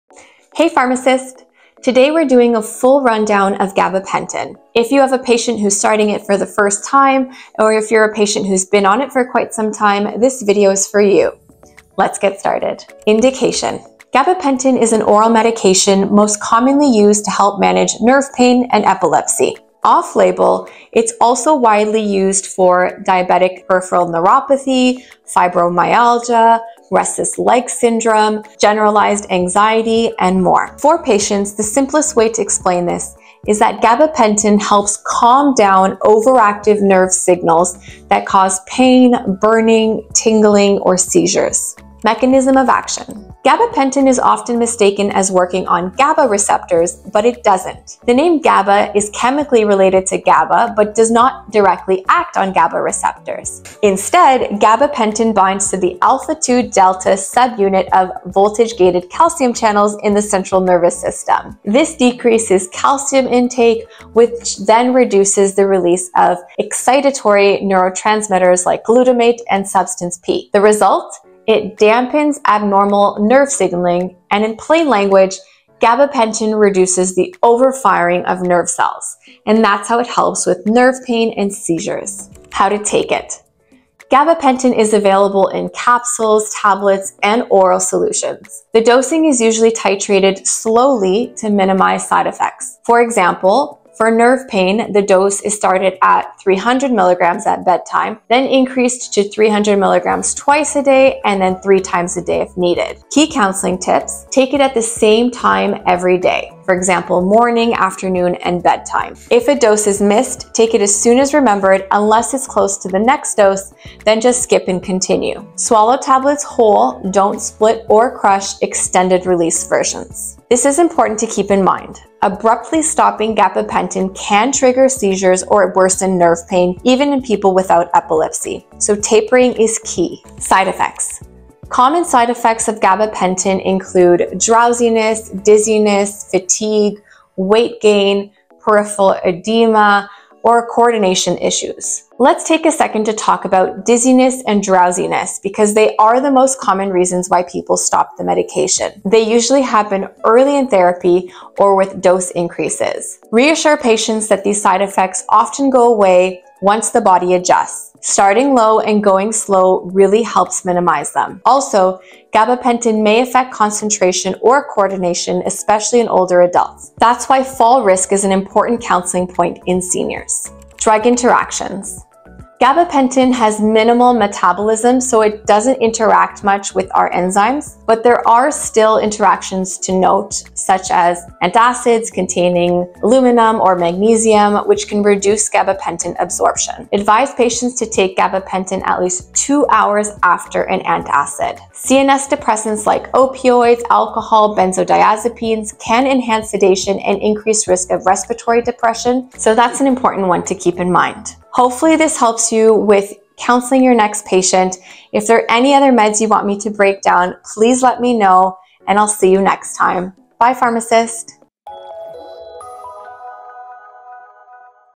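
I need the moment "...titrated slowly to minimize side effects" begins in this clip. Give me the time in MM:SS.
01:29.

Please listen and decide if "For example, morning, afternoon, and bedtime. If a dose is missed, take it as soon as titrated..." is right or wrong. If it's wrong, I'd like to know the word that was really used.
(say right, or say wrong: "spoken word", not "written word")
wrong: "remembered", not "titrated".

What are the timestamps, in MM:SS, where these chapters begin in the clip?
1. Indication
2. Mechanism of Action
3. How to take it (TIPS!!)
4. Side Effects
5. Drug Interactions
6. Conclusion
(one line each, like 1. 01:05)
1. 00:12
2. 00:41
3. 01:22
4. 02:10
5. 02:50
6. 03:21.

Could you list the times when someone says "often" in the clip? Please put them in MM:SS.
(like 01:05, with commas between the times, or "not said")
00:44, 02:35.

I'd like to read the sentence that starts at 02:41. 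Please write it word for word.
Also, gabapentin may affect concentration or coordination, especially in older adults.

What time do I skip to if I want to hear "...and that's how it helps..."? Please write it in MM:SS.
01:19.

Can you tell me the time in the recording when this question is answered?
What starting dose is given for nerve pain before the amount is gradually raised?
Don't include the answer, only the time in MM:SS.
01:36.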